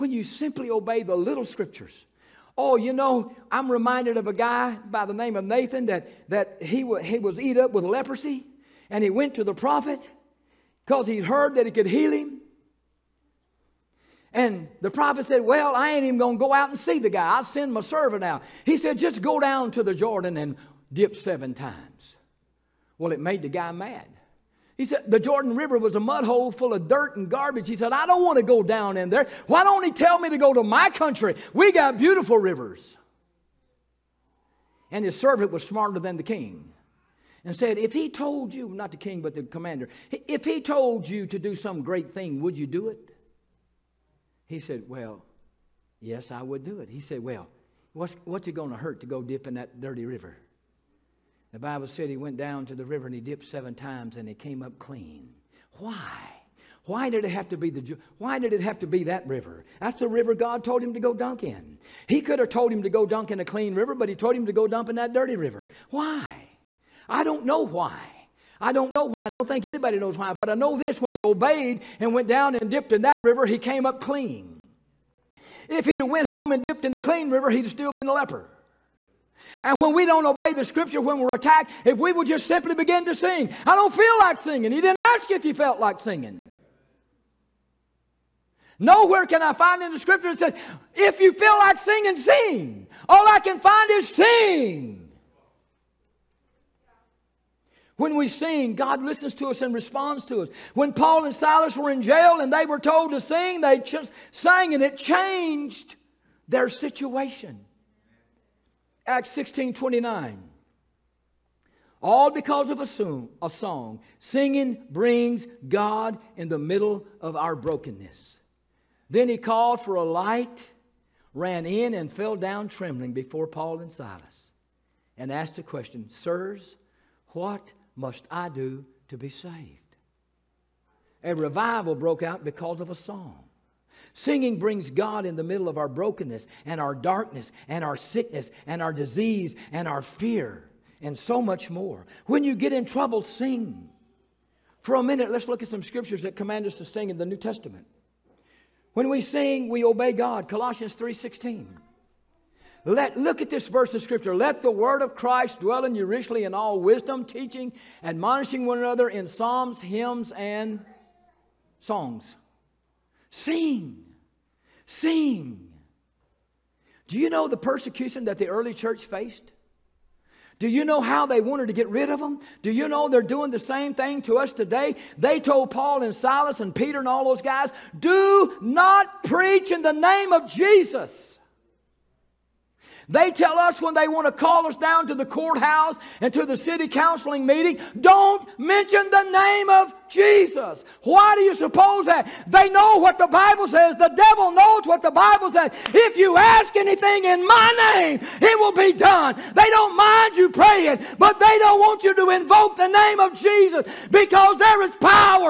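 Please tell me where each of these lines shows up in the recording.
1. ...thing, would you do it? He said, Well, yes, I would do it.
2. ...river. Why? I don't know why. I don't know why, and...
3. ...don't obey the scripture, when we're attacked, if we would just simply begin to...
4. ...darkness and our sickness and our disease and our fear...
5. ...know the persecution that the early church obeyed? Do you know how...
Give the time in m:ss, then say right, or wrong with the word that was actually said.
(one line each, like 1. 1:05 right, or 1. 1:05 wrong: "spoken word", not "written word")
1. 0:42 right
2. 1:05 right
3. 1:20 right
4. 2:16 right
5. 2:47 wrong: "faced", not "obeyed".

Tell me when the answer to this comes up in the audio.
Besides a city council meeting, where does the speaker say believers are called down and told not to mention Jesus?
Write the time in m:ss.
3:05.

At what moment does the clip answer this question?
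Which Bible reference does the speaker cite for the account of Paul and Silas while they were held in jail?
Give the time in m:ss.
1:49.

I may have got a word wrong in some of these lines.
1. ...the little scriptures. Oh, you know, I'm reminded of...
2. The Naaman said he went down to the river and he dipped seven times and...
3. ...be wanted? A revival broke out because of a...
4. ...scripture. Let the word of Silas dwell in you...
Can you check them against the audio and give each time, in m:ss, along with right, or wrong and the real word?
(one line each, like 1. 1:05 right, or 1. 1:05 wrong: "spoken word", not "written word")
1. 0:01 right
2. 0:51 wrong: "Bible", not "Naaman"
3. 2:09 wrong: "saved", not "wanted"
4. 2:33 wrong: "Christ", not "Silas".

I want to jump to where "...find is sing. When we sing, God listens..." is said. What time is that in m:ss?
1:33.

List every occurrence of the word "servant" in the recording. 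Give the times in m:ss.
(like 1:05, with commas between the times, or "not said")
0:17, 0:35.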